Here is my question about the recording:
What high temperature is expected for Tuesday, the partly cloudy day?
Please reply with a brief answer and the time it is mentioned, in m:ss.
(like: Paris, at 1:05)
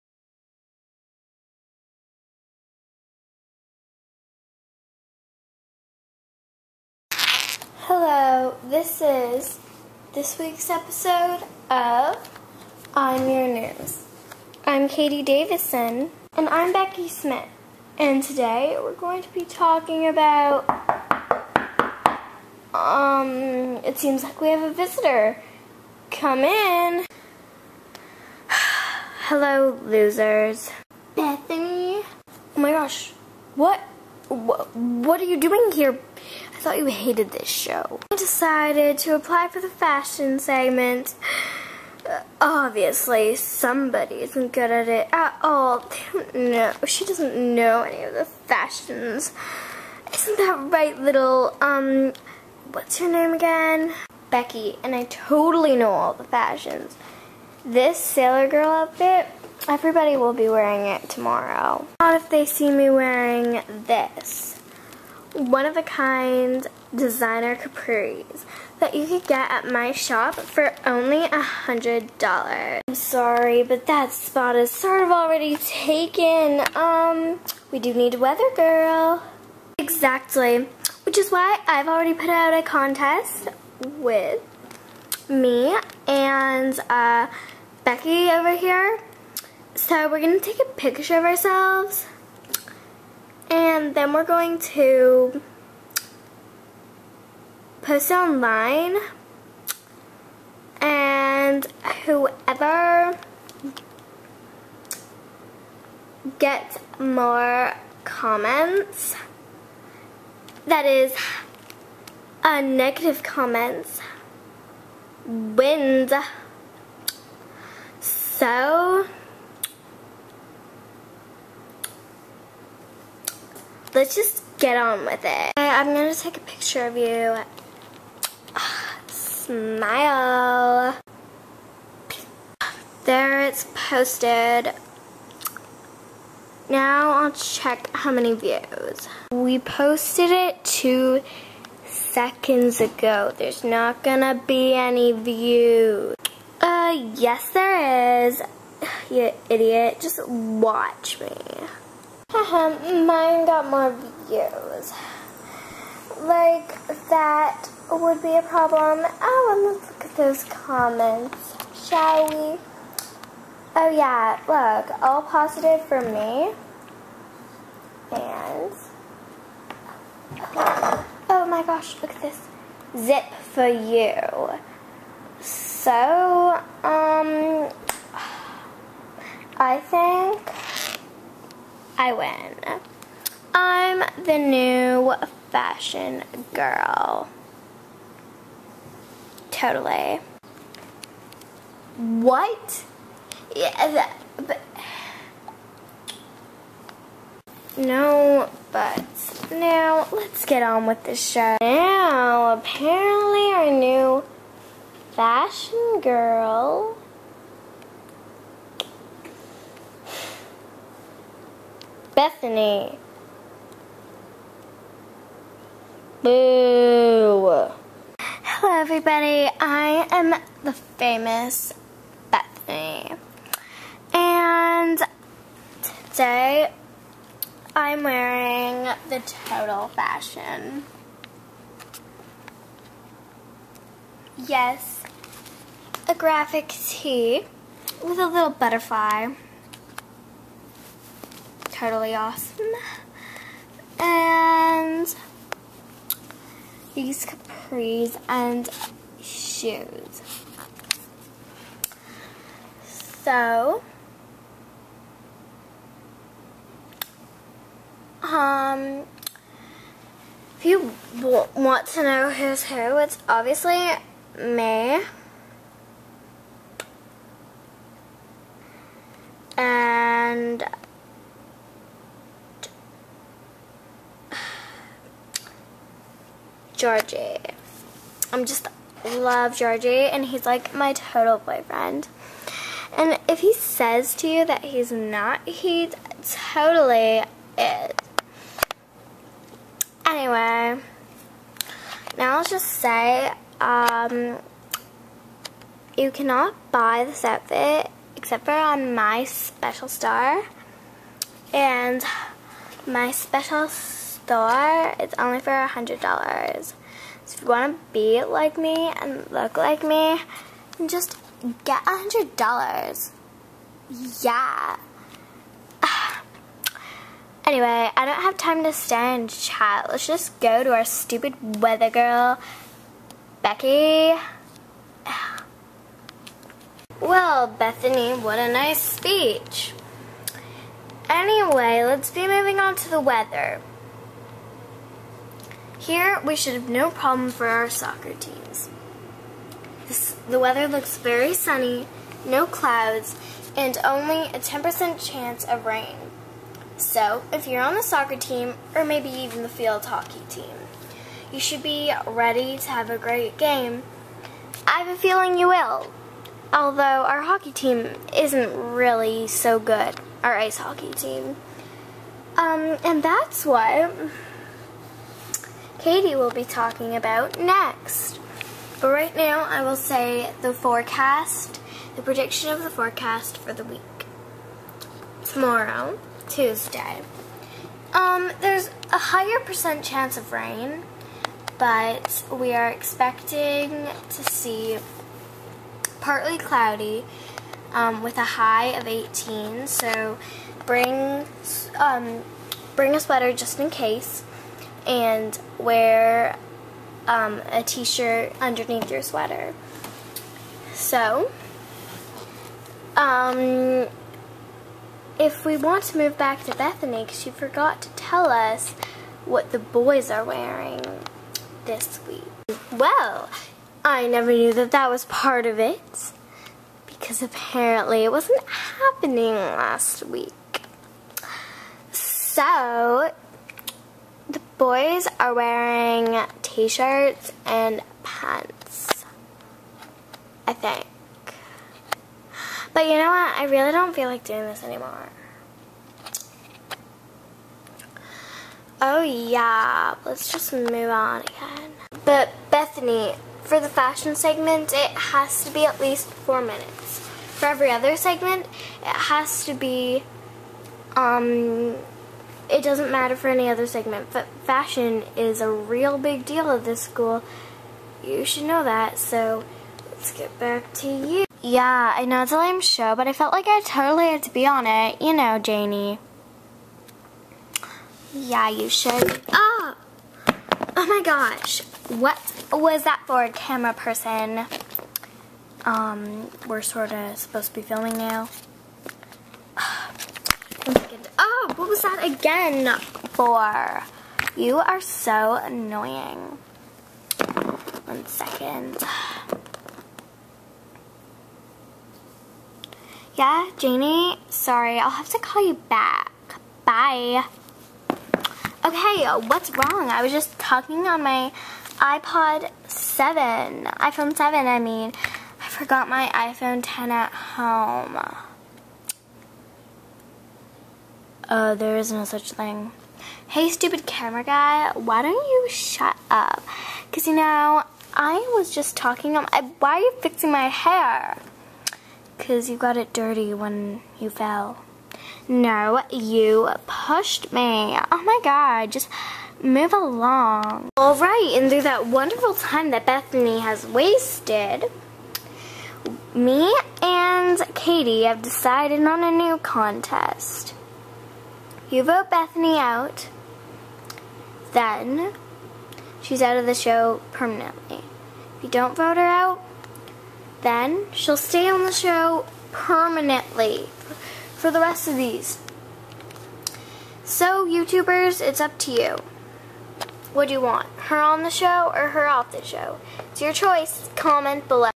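18, at 6:28.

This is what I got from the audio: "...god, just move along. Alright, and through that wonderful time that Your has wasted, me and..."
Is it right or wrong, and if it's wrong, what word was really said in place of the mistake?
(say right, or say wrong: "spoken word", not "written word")
wrong: "Bethany", not "Your".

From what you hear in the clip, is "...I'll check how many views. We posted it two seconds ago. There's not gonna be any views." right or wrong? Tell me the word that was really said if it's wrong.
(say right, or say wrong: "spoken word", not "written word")
right.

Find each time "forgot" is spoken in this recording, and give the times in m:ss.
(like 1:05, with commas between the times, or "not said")
6:47, 8:25.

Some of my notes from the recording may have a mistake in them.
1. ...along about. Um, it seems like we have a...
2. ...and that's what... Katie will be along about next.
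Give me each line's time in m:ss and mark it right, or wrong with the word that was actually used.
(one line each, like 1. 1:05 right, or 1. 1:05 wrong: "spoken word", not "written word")
1. 0:19 wrong: "talking", not "along"
2. 6:02 wrong: "talking", not "along".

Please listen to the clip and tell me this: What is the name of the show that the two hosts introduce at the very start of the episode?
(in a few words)
I'm Your News.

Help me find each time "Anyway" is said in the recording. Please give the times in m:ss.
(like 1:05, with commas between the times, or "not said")
4:50, 5:17, 5:31.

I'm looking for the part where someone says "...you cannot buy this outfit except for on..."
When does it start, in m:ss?
4:55.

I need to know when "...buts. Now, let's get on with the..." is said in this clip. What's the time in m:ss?
3:18.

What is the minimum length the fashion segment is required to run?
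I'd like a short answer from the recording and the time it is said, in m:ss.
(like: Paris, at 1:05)
four minutes, at 7:26.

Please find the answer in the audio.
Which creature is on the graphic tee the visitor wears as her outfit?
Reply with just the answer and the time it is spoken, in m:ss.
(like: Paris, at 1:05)
butterfly, at 3:58.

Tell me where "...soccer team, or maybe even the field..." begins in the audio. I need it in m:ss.
5:47.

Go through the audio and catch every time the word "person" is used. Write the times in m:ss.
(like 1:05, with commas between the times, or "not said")
7:53.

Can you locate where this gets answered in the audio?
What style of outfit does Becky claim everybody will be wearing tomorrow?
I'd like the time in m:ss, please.
0:57.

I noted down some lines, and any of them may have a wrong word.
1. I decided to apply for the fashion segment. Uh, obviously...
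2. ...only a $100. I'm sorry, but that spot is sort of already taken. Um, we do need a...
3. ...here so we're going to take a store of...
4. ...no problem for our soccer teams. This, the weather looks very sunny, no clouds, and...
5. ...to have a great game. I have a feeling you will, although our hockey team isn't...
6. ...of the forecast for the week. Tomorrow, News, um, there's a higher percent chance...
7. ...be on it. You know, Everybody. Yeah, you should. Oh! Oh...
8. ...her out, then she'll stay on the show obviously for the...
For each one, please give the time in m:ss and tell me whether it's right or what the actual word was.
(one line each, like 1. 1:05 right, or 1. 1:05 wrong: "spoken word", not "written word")
1. 0:38 right
2. 1:10 right
3. 1:28 wrong: "picture", not "store"
4. 5:36 right
5. 5:52 right
6. 6:12 wrong: "Tuesday", not "News"
7. 7:44 wrong: "Janie", not "Everybody"
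8. 9:08 wrong: "permanently", not "obviously".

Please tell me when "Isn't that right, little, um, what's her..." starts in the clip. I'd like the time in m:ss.
0:50.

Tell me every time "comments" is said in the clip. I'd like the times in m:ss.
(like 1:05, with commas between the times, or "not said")
1:48, 1:53, 2:40, 9:23.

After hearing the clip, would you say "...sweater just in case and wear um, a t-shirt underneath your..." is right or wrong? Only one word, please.
right.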